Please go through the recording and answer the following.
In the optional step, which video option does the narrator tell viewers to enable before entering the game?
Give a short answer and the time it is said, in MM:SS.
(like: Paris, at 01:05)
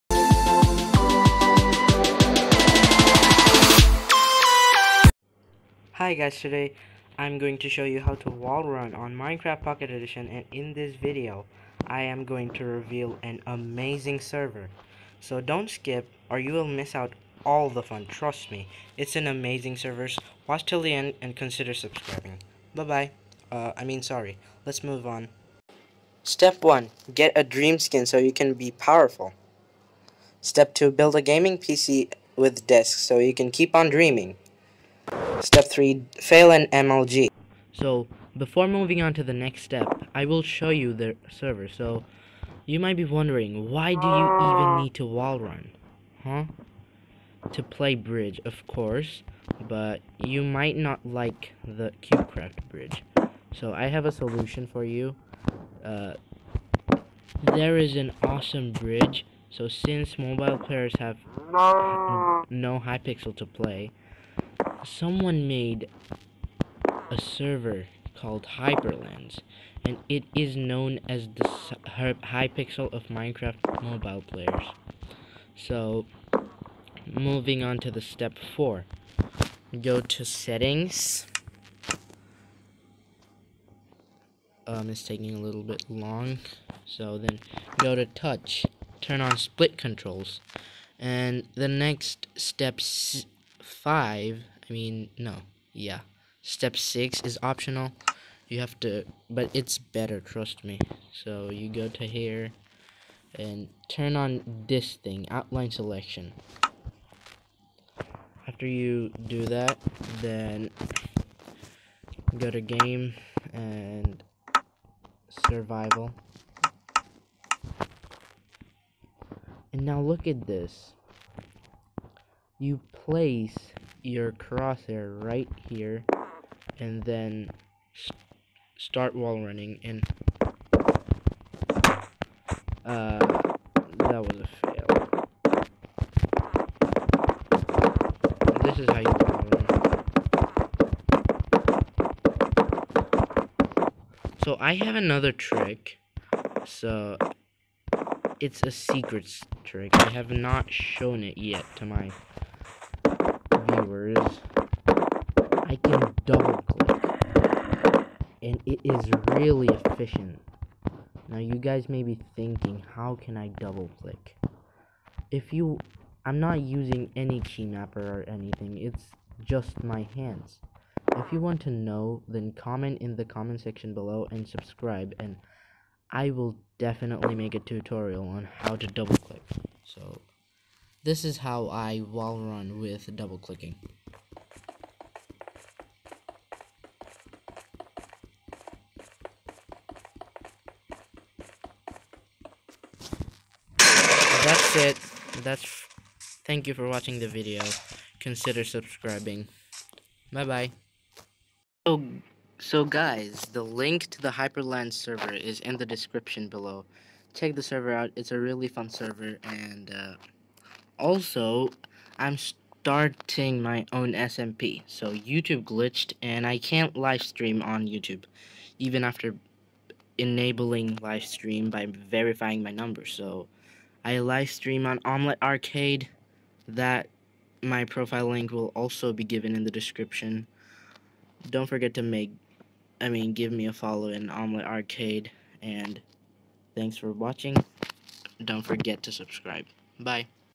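outline selection, at 01:45.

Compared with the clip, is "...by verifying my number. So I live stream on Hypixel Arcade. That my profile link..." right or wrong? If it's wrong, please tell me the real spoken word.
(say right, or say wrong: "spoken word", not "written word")
wrong: "Omlet", not "Hypixel".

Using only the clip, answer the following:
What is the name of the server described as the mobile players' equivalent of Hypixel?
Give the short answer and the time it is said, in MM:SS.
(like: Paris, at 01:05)
Hyperlands, at 01:08.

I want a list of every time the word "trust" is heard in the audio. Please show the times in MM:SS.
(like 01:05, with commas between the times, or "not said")
00:18, 01:40.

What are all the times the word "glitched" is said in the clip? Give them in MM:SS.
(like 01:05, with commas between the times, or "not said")
03:35.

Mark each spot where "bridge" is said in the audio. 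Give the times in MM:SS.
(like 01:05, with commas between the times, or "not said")
00:47, 00:52, 00:58.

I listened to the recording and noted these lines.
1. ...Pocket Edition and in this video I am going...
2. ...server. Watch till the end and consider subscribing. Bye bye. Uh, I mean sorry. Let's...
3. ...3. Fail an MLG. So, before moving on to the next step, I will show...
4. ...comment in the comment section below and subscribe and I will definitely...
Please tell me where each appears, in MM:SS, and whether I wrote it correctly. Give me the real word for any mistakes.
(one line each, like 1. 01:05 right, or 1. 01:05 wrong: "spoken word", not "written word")
1. 00:09 right
2. 00:19 right
3. 00:35 right
4. 02:52 right.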